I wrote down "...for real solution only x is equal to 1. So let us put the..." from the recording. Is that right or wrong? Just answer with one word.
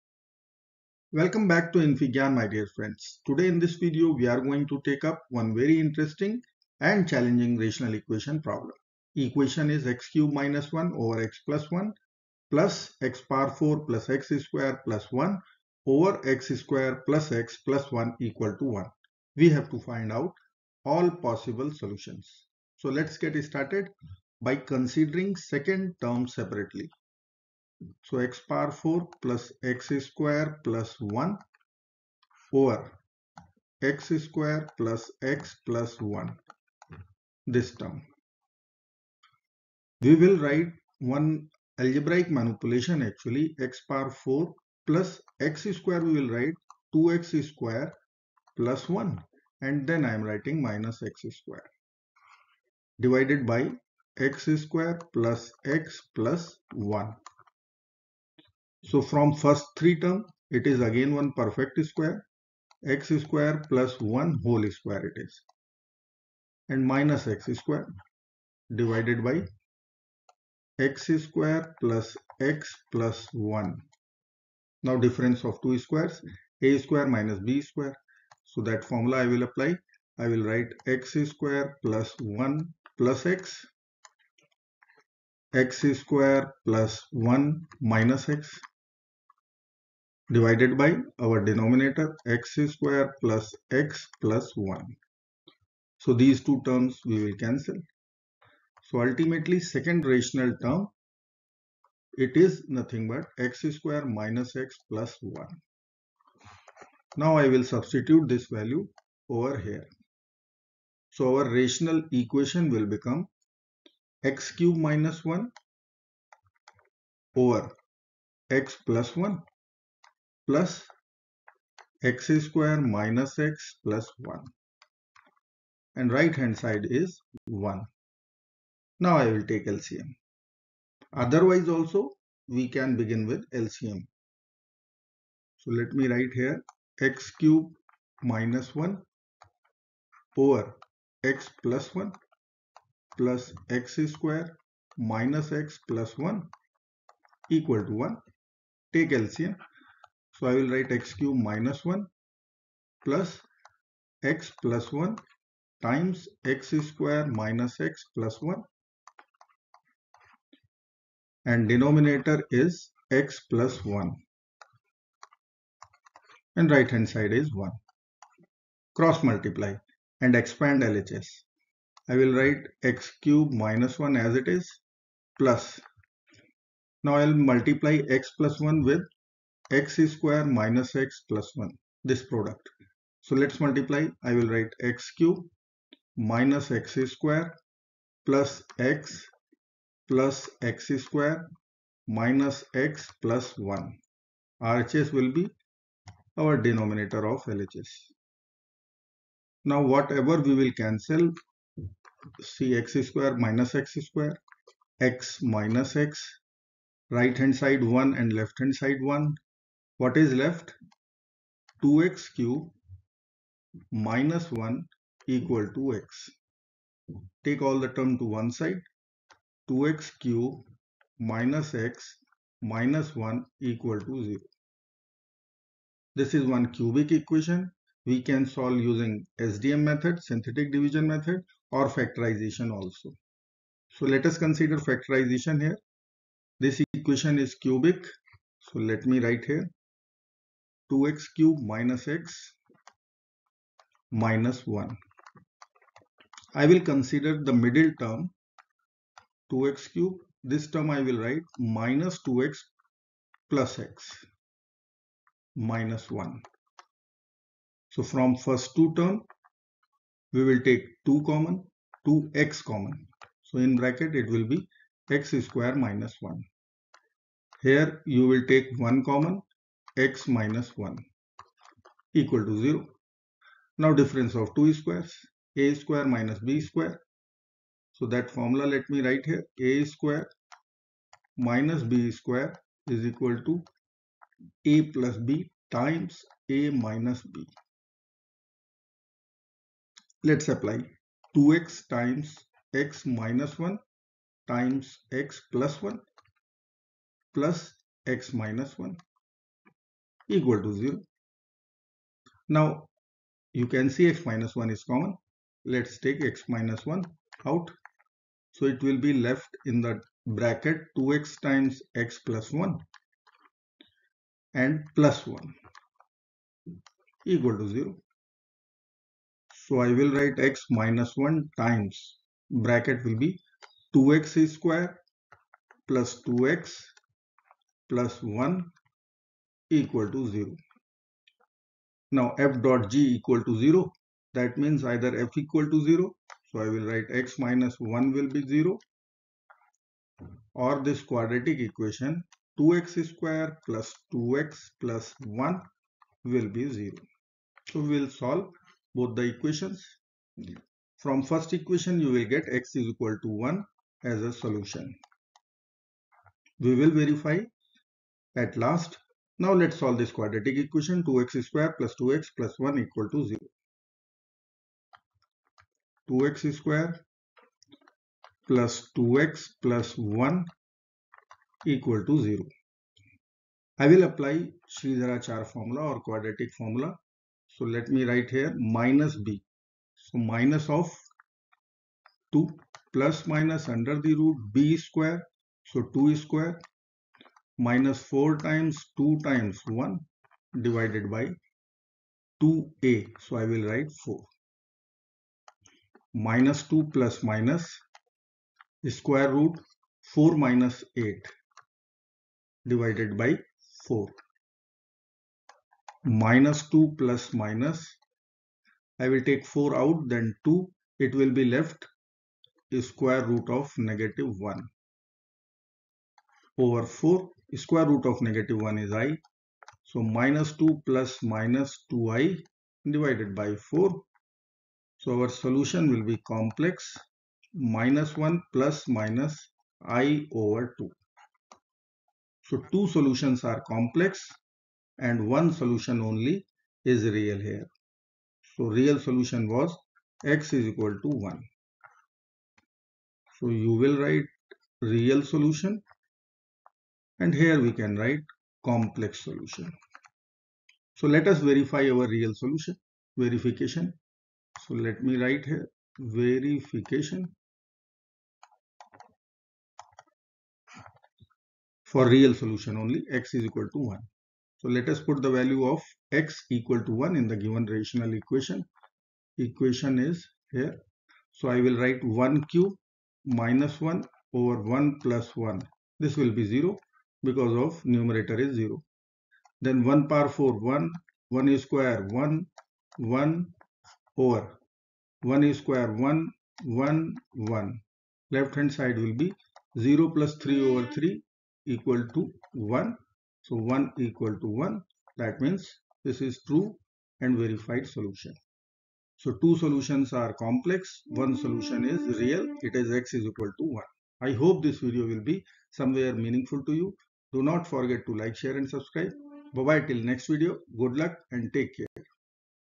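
right.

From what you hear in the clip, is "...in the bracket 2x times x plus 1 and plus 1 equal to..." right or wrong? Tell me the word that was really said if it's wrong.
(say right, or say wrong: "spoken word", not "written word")
right.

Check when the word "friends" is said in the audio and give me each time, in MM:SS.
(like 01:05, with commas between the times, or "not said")
00:02.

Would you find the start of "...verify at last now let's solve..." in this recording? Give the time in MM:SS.
05:56.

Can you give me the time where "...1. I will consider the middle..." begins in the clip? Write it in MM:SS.
04:04.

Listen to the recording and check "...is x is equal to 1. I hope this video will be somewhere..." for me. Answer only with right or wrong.
right.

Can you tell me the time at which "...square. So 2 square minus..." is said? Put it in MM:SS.
06:24.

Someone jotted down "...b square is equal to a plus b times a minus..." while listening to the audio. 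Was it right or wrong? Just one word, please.
right.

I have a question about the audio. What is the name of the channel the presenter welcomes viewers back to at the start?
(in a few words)
infyGyan.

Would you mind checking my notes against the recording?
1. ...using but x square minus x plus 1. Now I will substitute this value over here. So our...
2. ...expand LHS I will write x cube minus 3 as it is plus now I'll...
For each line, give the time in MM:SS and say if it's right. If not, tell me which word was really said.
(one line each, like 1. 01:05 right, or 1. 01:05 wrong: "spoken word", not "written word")
1. 01:42 wrong: "nothing", not "using"
2. 02:50 wrong: "1", not "3".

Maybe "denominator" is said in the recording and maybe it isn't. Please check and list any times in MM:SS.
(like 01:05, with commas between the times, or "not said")
01:31, 02:41, 03:16.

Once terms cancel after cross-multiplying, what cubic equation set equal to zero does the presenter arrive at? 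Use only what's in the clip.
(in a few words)
2x^3 - x - 1 = 0.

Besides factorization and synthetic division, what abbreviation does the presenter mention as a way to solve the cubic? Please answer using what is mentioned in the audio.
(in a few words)
SDM.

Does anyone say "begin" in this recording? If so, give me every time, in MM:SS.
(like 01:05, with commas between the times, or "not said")
02:12.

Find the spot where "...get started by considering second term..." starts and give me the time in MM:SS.
00:23.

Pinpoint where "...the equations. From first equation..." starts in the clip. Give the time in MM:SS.
05:49.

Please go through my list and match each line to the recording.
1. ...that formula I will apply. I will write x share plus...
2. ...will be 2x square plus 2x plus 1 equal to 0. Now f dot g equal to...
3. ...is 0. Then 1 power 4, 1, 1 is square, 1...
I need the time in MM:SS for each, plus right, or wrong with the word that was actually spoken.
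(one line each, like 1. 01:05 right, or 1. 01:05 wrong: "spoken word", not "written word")
1. 01:18 wrong: "square", not "share"
2. 05:23 right
3. 07:58 right.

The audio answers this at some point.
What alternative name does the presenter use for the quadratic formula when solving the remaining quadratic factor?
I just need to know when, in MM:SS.
06:14.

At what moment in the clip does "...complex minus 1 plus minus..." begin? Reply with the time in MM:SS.
07:06.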